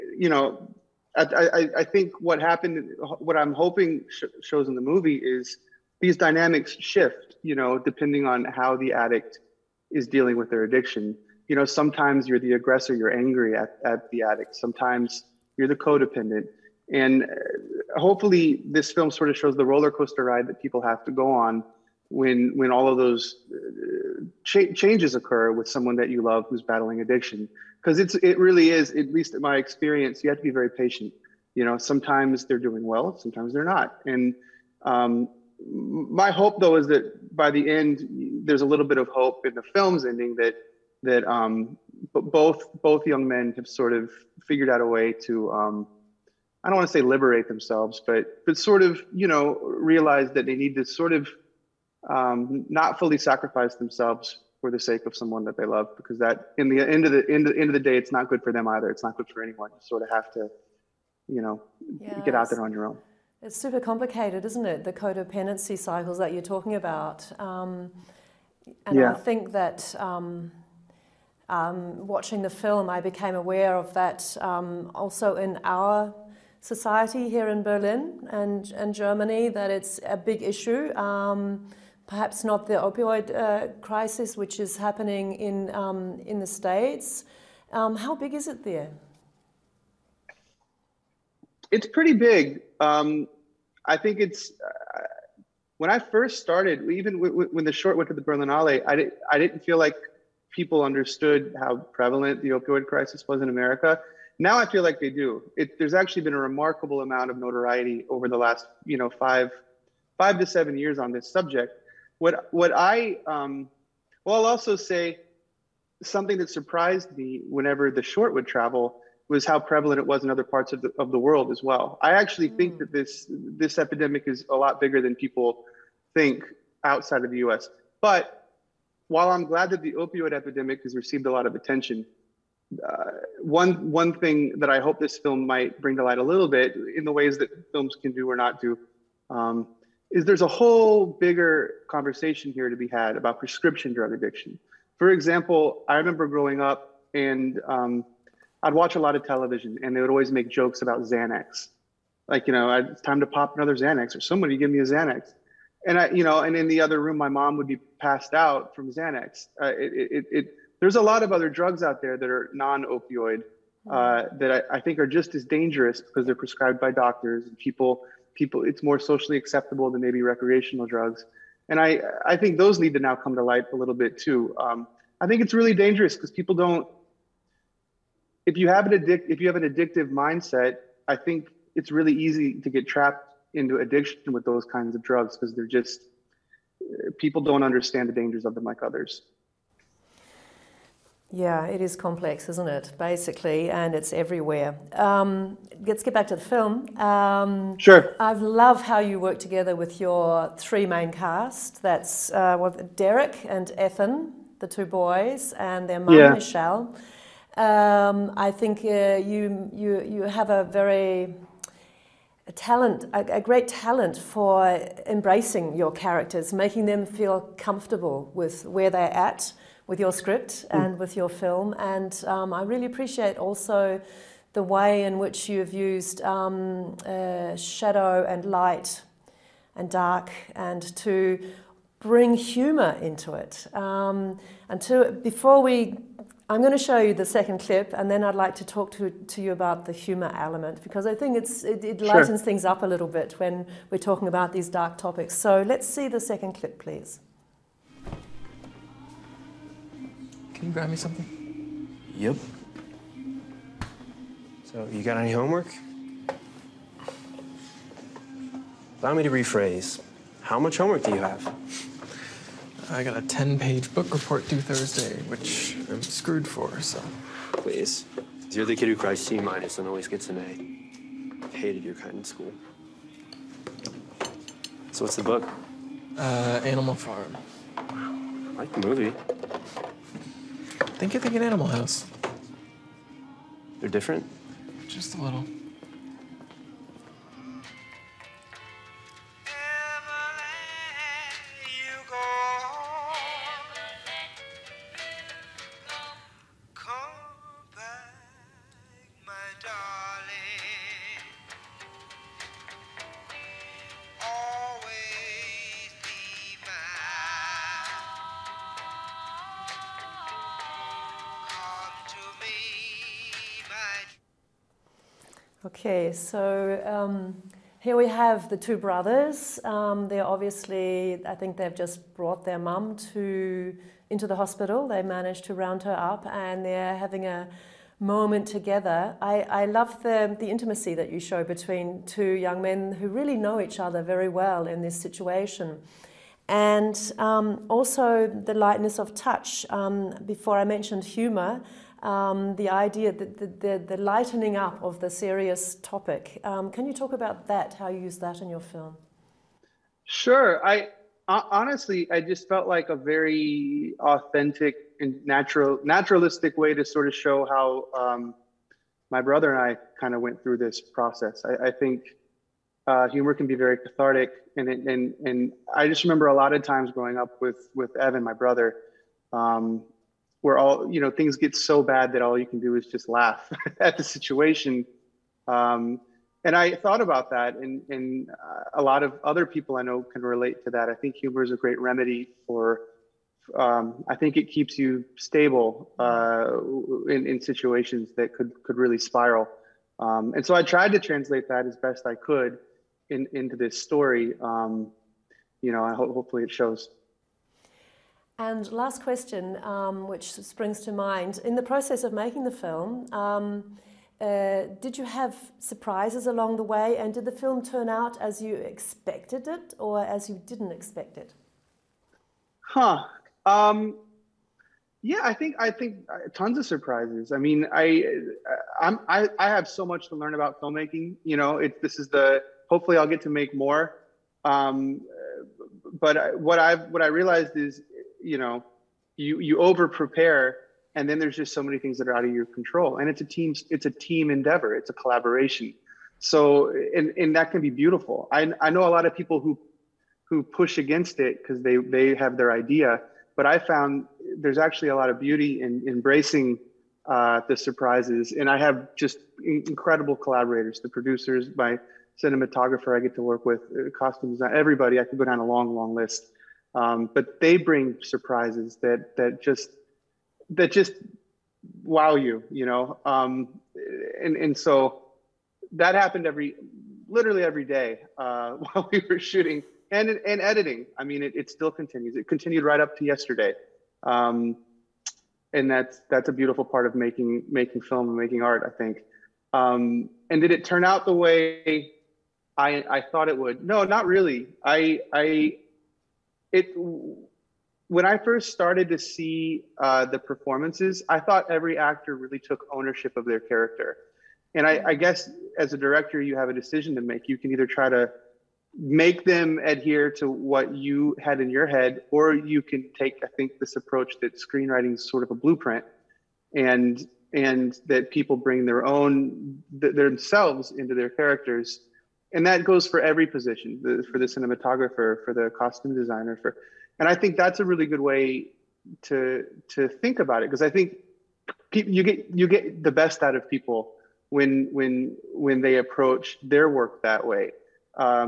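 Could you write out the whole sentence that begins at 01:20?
Um, perhaps not the opioid uh, crisis, which is happening in, um, in the States.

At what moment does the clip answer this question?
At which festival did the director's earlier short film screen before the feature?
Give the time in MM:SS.
01:38.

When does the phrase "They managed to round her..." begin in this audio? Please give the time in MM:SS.
05:24.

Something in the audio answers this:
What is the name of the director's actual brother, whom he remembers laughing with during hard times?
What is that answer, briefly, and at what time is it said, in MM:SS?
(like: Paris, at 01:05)
Evan, at 06:07.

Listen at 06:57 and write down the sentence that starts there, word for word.
I mean, I uh, I'm, I I have so much to learn about filmmaking.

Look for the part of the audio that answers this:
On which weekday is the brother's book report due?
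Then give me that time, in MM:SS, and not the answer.
04:24.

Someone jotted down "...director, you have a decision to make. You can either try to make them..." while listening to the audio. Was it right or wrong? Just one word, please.
right.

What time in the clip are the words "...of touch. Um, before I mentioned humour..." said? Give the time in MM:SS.
05:38.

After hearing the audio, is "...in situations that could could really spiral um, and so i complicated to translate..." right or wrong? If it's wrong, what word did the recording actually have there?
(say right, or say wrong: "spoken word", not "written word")
wrong: "tried", not "complicated".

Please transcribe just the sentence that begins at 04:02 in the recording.
things up a little bit when we're talking about these dark topics.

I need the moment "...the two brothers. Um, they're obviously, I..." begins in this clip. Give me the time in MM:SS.
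05:18.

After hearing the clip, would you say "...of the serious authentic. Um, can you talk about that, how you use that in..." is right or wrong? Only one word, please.
wrong.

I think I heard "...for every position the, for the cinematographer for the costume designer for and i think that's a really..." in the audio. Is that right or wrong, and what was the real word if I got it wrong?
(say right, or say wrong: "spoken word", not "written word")
right.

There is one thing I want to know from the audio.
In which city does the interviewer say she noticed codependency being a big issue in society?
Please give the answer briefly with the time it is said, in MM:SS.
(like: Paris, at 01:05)
Berlin, at 01:17.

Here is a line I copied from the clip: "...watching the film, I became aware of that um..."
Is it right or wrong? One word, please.
right.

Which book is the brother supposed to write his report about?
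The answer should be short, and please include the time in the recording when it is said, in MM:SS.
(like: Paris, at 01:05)
Animal Farm, at 04:36.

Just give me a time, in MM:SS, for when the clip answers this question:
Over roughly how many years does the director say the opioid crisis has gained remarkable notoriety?
01:50.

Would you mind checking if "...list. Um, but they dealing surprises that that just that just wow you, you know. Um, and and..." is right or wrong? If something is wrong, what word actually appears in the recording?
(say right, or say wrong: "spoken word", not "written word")
wrong: "bring", not "dealing".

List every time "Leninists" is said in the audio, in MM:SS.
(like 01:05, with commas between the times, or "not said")
not said.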